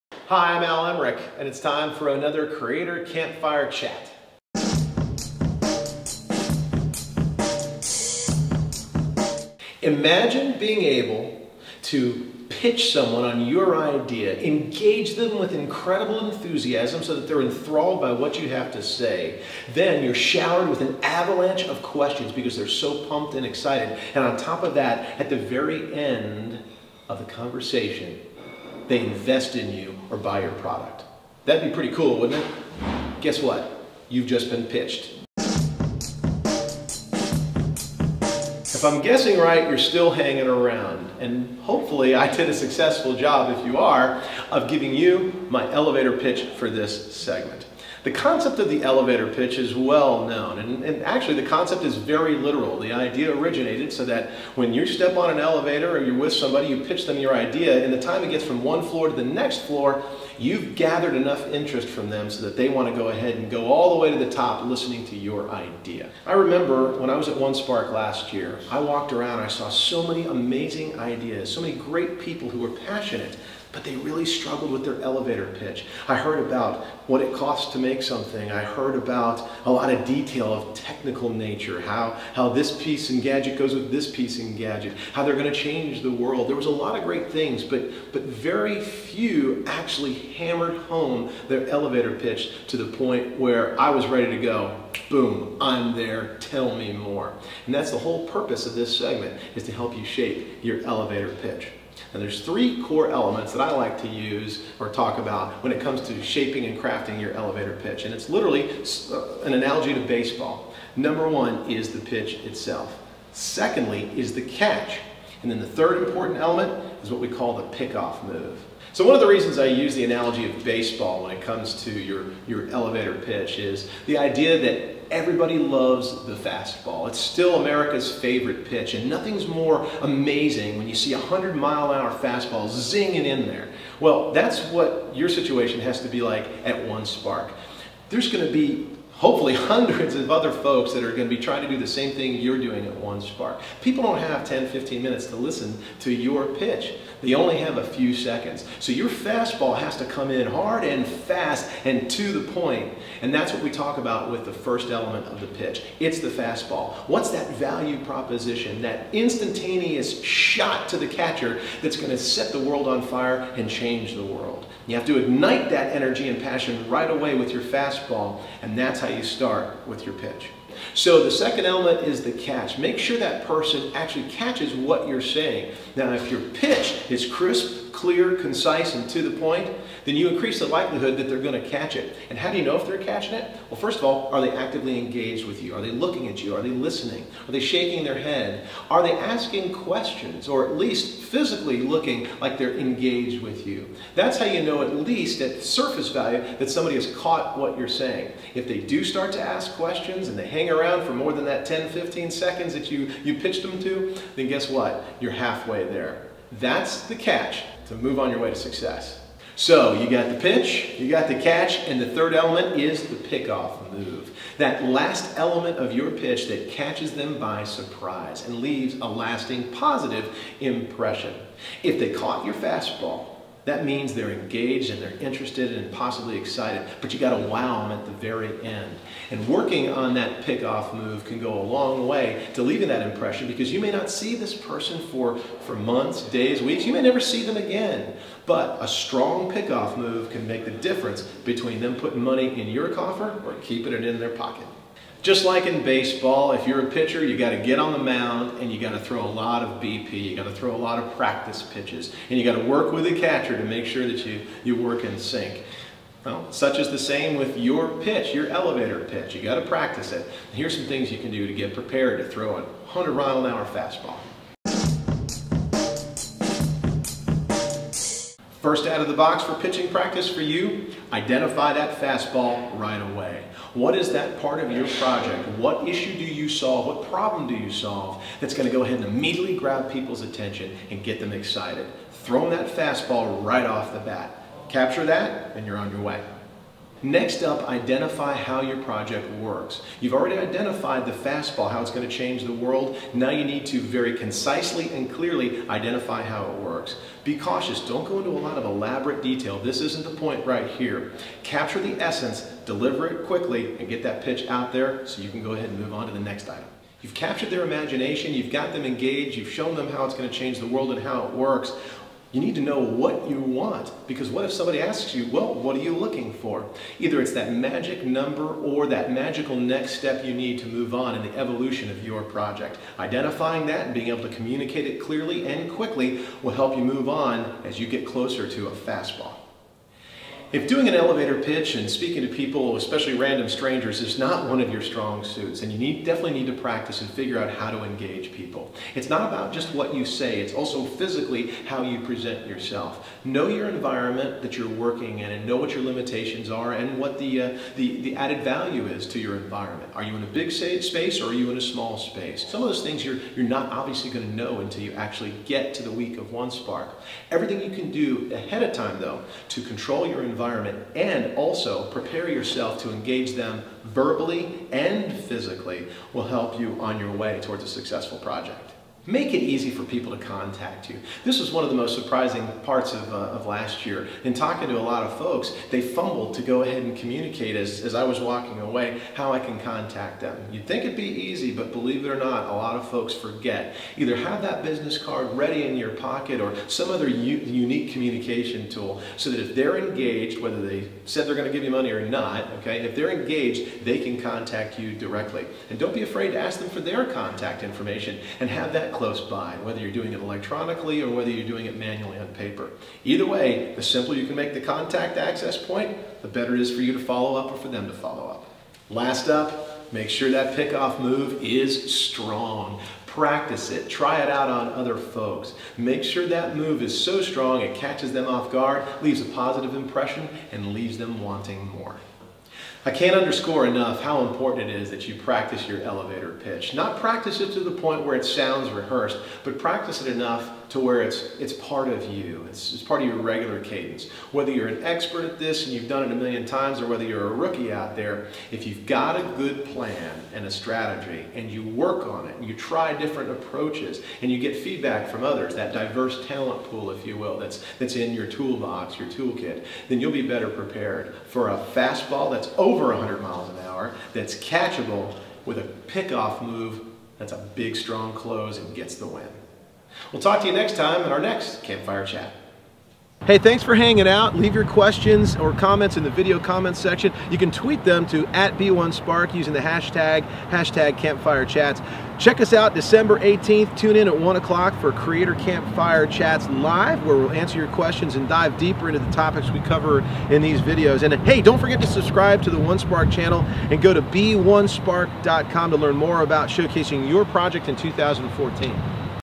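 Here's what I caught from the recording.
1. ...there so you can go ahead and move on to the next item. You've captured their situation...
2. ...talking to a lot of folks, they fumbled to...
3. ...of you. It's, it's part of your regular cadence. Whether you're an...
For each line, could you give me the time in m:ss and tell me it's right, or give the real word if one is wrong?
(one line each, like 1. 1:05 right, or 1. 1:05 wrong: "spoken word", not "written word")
1. 5:04 wrong: "imagination", not "situation"
2. 6:14 right
3. 7:11 right.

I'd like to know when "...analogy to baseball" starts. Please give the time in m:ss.
1:49.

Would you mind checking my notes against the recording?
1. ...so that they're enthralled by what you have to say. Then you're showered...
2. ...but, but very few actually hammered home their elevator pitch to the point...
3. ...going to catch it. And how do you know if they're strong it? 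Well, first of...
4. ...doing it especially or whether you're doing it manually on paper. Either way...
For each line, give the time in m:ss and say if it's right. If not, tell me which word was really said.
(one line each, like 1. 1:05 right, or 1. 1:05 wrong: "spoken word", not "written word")
1. 0:17 right
2. 1:27 right
3. 3:01 wrong: "catching", not "strong"
4. 6:39 wrong: "electronically", not "especially".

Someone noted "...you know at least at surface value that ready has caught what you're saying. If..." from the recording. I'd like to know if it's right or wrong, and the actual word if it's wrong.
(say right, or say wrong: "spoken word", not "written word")
wrong: "somebody", not "ready".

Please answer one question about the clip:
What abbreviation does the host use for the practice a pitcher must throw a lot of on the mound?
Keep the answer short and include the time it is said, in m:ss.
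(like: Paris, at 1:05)
BP, at 4:09.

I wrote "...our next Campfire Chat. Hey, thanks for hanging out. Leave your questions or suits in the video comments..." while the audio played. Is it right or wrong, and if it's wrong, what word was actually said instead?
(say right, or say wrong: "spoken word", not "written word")
wrong: "comments", not "suits".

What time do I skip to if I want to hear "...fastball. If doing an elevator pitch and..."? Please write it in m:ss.
5:28.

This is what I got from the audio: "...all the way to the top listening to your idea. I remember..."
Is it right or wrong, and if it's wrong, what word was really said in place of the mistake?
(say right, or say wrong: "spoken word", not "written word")
right.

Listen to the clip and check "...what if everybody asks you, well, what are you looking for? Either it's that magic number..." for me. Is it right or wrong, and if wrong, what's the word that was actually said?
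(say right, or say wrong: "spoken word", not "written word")
wrong: "somebody", not "everybody".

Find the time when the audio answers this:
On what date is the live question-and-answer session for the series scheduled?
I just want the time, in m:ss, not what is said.
7:52.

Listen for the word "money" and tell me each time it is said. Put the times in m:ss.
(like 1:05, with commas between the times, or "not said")
4:02, 6:31.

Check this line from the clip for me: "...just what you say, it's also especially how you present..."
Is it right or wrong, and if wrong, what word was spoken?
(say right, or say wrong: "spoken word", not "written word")
wrong: "physically", not "especially".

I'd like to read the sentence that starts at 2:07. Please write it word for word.
It's still America's favorite pitch, and nothing's more amazing when you see a 100 mile an hour fastball zinging in there.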